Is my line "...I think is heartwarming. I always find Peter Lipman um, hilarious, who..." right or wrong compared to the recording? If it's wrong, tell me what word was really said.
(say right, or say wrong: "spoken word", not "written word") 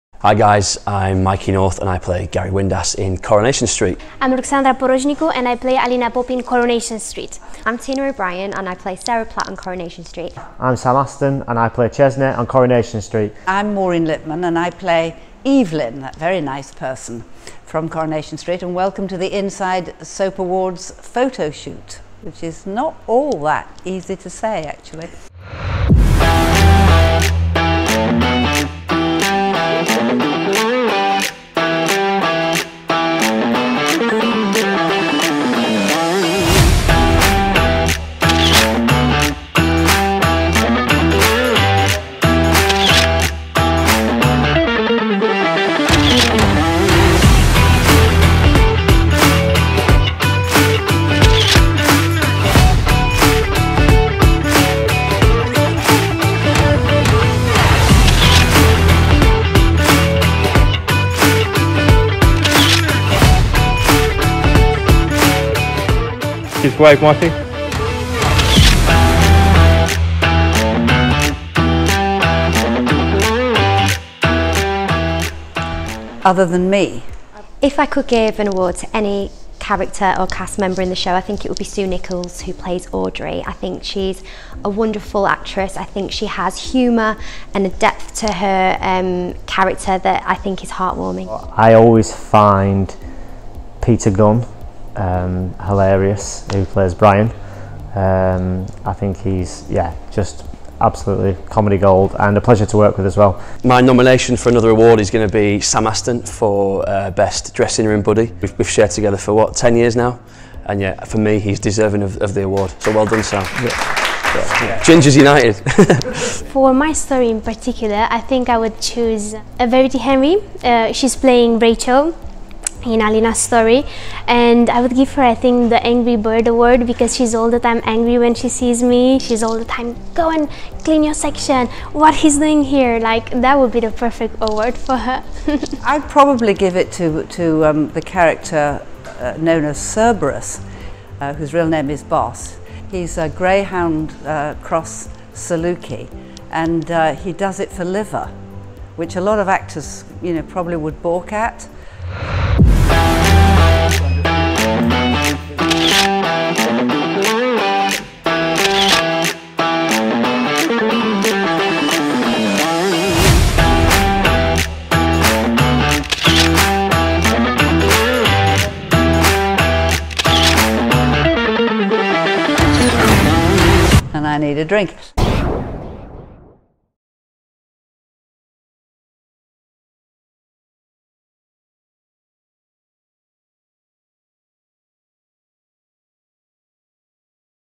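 wrong: "Gunn", not "Lipman".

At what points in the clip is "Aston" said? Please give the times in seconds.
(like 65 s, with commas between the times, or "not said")
10 s, 105 s.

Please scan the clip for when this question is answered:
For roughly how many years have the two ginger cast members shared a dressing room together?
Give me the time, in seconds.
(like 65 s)
109 s.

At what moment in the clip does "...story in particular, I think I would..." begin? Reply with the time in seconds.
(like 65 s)
116 s.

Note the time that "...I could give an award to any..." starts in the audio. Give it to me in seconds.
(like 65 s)
77 s.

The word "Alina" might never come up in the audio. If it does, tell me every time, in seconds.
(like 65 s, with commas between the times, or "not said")
5 s, 122 s.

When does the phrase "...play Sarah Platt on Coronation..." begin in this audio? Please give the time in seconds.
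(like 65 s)
8 s.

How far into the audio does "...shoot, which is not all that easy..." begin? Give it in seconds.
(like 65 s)
21 s.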